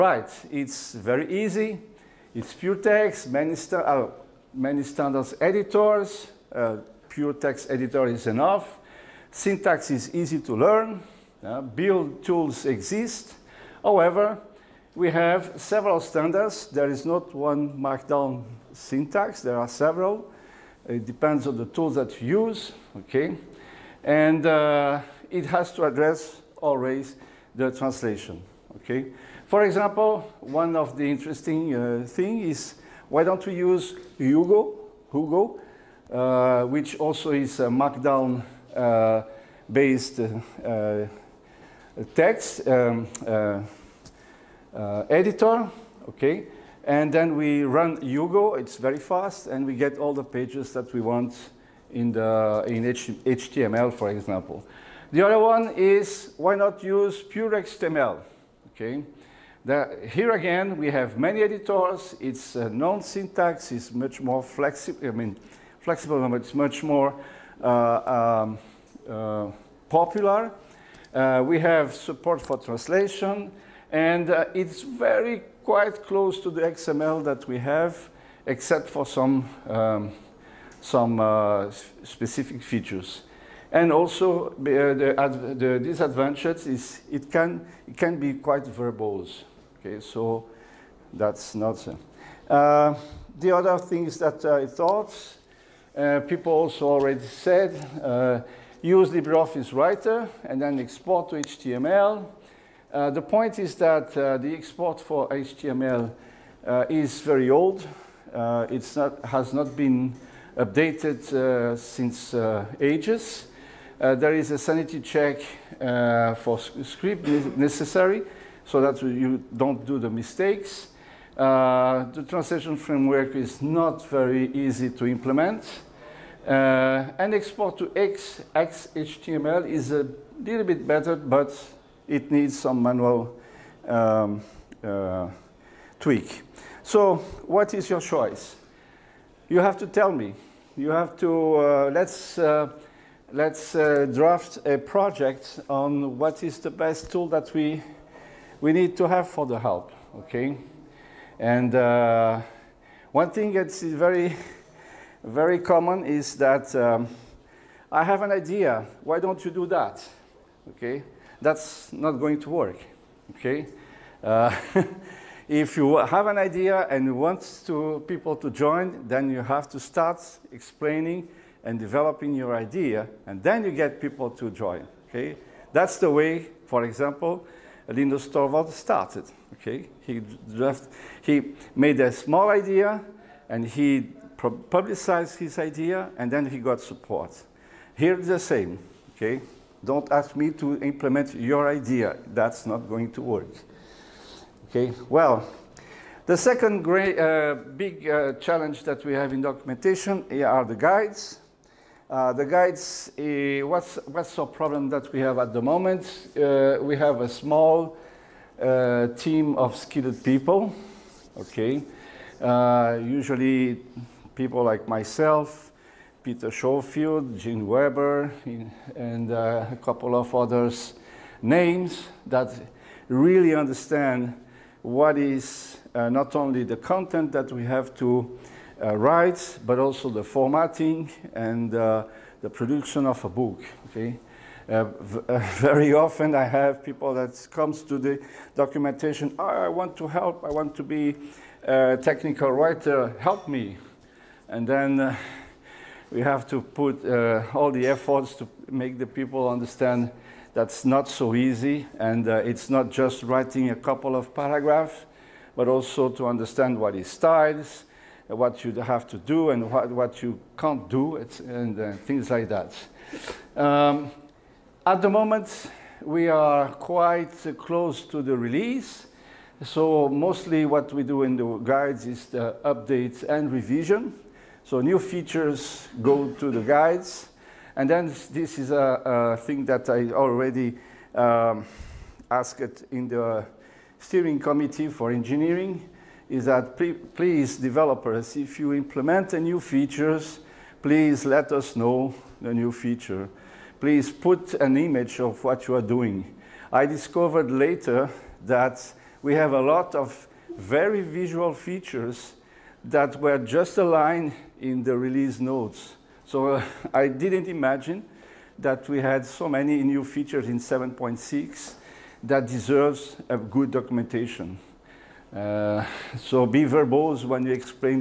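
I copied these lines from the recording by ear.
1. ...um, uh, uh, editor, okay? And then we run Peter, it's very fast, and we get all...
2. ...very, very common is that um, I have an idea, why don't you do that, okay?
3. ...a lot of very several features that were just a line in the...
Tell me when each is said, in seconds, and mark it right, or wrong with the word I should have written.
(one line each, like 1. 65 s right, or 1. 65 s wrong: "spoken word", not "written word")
1. 42 s wrong: "Hugo", not "Peter"
2. 153 s right
3. 299 s wrong: "visual", not "several".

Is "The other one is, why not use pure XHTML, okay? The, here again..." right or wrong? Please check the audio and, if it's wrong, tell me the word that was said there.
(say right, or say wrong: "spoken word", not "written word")
wrong: "XML", not "XHTML".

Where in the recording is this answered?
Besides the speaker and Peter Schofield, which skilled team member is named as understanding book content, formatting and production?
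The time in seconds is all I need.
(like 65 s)
217 s.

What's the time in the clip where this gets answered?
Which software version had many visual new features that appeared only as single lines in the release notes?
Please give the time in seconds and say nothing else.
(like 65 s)
310 s.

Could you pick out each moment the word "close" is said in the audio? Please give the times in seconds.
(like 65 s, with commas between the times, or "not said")
76 s, 267 s.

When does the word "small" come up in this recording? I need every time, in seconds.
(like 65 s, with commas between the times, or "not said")
182 s, 207 s.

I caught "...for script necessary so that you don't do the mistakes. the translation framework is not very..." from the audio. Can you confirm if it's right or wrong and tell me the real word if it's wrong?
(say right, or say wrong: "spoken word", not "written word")
right.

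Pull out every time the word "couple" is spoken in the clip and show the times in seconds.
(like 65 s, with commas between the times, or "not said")
219 s, 253 s.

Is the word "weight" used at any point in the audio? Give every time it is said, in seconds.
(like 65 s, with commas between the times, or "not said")
not said.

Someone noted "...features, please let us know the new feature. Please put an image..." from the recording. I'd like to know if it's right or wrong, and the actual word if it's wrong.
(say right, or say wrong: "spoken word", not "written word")
right.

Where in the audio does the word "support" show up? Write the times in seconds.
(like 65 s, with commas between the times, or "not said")
71 s, 186 s.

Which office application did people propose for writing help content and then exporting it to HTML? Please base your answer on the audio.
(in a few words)
LibreOffice Writer.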